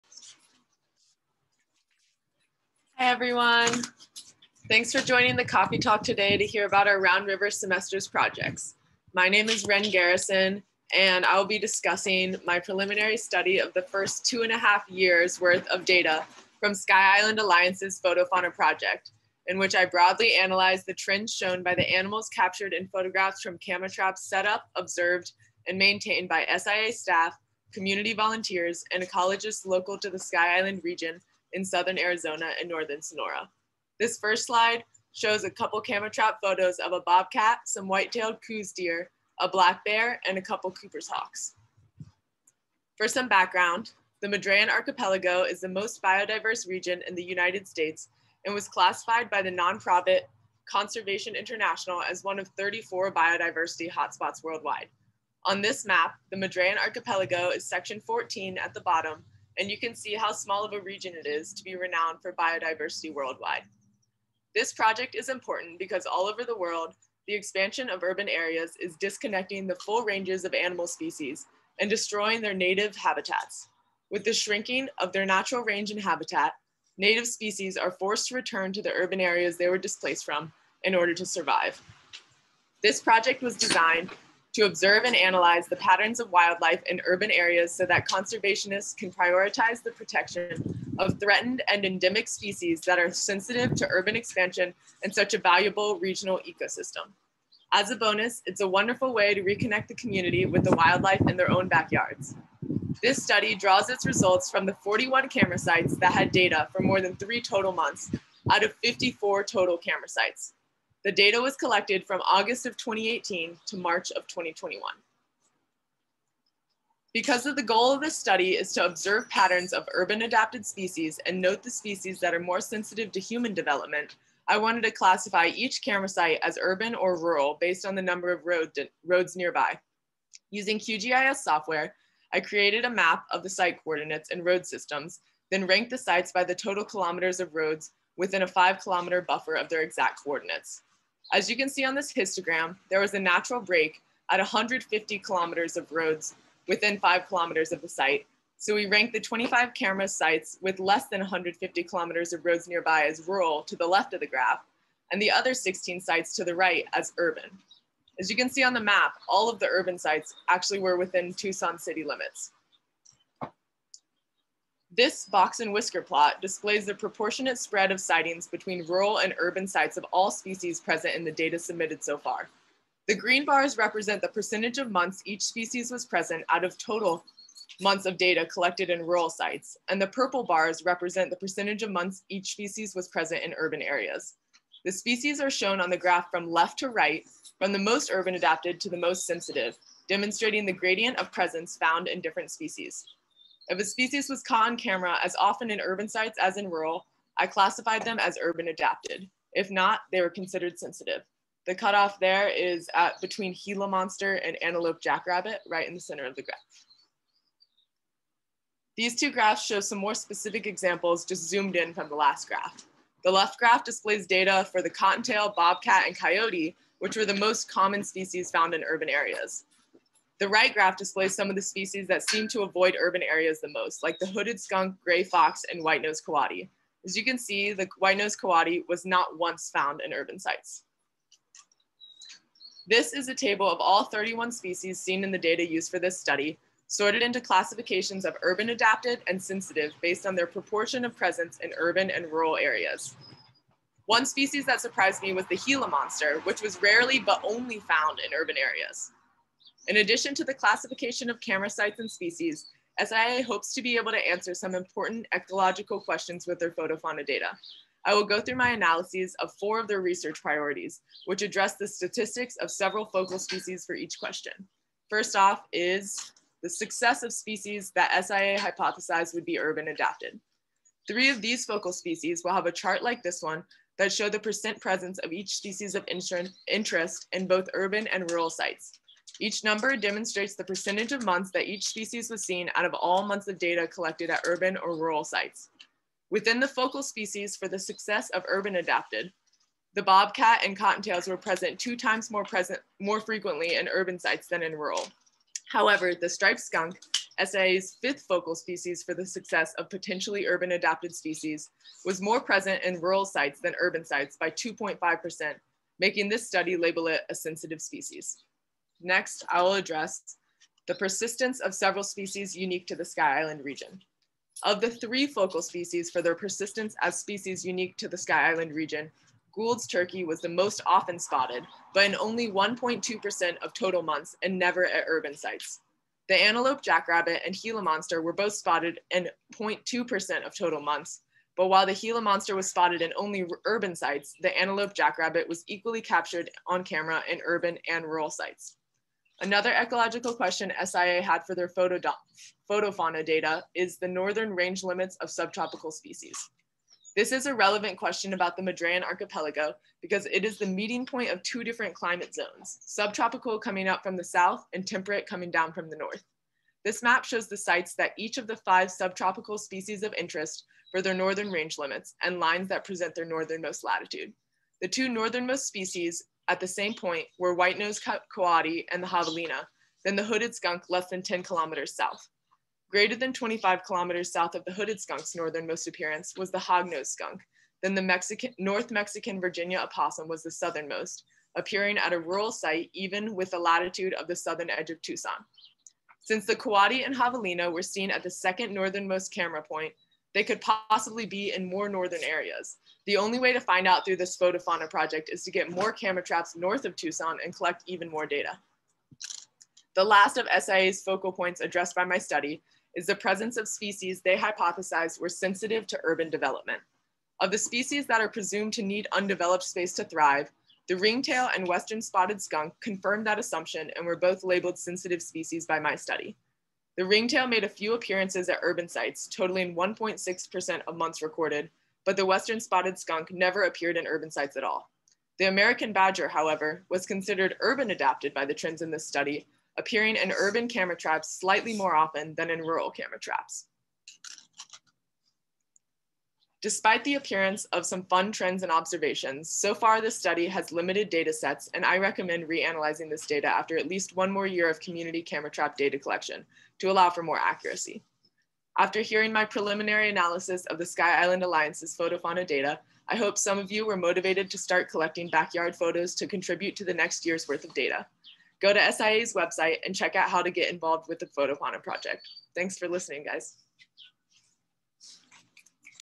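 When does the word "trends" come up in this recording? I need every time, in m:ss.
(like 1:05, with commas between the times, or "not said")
0:20, 7:08, 7:18.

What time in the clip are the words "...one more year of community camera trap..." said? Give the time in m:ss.
7:24.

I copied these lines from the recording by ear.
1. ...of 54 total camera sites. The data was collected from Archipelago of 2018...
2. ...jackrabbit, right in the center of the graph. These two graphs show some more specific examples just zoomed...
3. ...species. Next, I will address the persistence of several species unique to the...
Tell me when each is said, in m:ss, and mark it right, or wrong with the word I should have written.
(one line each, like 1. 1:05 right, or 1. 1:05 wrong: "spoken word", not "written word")
1. 1:48 wrong: "August", not "Archipelago"
2. 3:25 right
3. 5:07 right.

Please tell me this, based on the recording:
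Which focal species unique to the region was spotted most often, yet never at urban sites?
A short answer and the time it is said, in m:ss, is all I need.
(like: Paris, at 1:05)
Gould's turkey, at 5:19.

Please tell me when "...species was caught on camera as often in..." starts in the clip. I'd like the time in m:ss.
3:13.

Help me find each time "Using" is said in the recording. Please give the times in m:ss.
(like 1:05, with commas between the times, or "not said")
2:10.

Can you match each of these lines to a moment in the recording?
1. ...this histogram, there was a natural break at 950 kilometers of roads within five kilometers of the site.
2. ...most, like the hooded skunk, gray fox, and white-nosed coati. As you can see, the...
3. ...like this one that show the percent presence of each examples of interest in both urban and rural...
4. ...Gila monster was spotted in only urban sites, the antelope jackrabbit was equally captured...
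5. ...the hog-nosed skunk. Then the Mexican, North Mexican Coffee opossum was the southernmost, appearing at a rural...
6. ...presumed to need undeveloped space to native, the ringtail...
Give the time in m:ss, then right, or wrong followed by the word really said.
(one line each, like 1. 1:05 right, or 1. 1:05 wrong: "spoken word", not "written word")
1. 2:21 wrong: "150", not "950"
2. 3:43 right
3. 4:33 wrong: "species", not "examples"
4. 5:31 right
5. 6:16 wrong: "Virginia", not "Coffee"
6. 6:48 wrong: "thrive", not "native".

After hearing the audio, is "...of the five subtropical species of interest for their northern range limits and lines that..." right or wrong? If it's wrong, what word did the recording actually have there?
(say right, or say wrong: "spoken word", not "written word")
right.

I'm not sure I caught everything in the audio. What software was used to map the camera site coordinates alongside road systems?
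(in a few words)
QGIS.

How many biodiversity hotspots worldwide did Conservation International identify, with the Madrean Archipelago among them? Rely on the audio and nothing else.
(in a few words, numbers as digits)
34.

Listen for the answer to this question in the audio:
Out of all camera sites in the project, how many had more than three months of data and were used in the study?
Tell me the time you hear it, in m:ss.
1:44.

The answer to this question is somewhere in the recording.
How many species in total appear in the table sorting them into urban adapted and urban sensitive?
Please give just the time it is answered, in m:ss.
3:54.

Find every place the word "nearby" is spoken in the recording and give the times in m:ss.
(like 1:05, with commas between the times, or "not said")
2:09, 2:32.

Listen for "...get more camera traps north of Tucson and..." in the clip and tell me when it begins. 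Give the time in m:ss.
6:35.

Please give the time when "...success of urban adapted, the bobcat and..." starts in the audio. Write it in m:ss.
4:47.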